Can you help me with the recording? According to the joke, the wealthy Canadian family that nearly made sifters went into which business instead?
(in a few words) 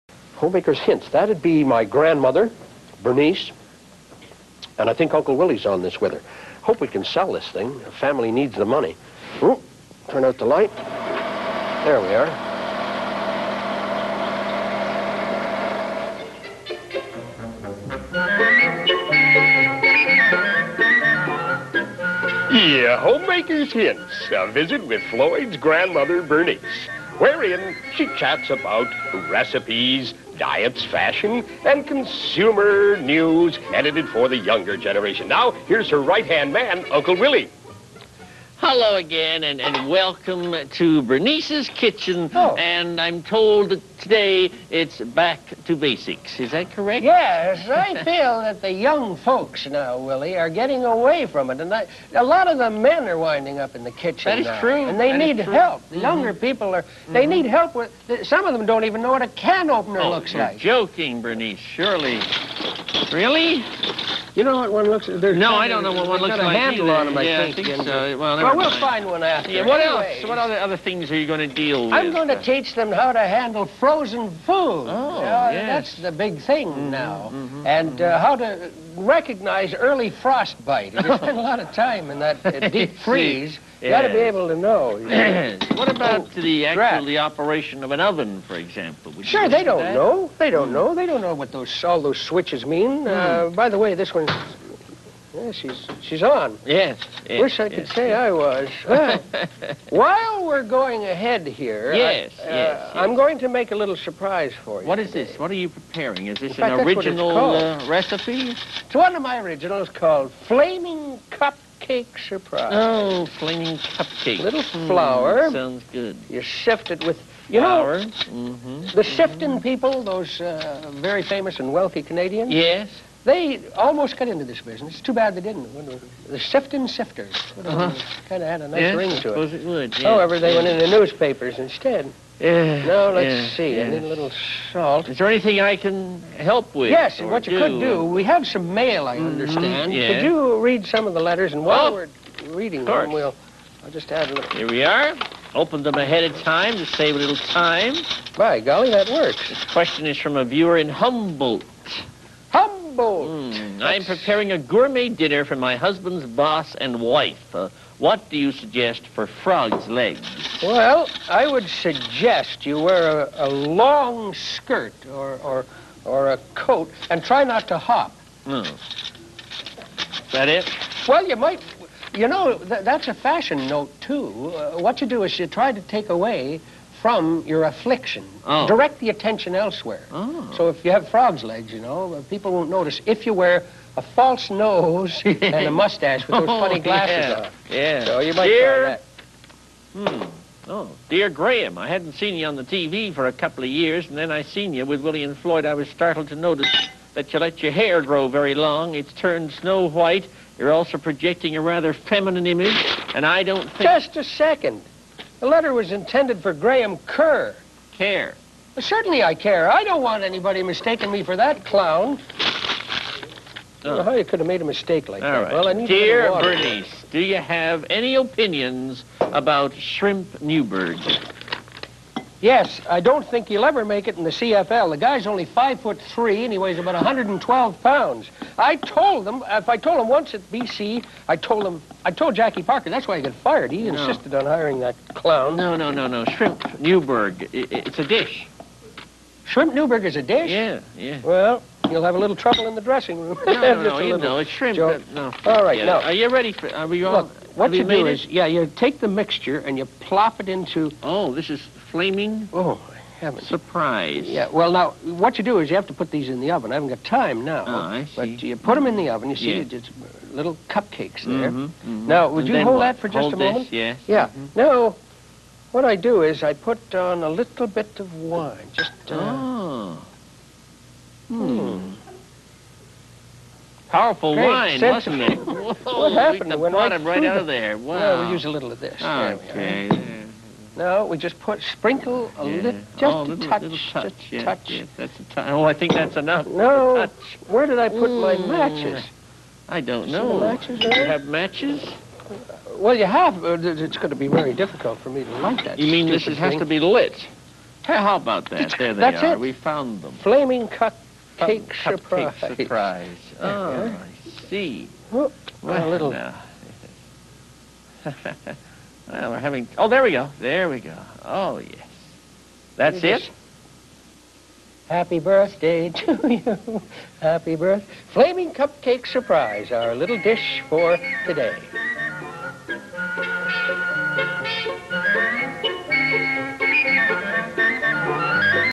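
newspapers.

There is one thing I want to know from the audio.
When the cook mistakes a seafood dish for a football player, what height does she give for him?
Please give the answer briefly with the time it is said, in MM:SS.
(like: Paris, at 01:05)
five foot three, at 03:45.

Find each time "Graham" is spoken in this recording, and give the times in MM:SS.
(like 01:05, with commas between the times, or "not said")
03:11, 03:26.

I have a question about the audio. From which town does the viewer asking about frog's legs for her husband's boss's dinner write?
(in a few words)
Humboldt.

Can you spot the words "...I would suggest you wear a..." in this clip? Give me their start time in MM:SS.
02:41.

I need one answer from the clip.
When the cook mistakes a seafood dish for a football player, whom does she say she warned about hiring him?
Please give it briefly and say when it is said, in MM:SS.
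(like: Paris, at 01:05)
Jackie Parker, at 03:52.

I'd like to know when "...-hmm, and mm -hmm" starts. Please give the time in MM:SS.
01:17.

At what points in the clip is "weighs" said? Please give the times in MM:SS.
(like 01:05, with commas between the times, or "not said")
03:46.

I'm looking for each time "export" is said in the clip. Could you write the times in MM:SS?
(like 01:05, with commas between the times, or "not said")
not said.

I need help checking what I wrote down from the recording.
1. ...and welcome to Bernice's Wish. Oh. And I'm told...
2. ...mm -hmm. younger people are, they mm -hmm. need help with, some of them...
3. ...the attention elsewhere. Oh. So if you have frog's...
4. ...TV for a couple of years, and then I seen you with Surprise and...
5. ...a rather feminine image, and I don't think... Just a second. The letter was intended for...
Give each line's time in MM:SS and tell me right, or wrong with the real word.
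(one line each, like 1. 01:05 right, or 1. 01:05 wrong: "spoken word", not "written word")
1. 00:39 wrong: "Kitchen", not "Wish"
2. 00:55 right
3. 02:58 right
4. 03:12 wrong: "Willy", not "Surprise"
5. 03:21 right.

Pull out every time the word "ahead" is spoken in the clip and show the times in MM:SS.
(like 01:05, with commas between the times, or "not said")
01:41, 02:25.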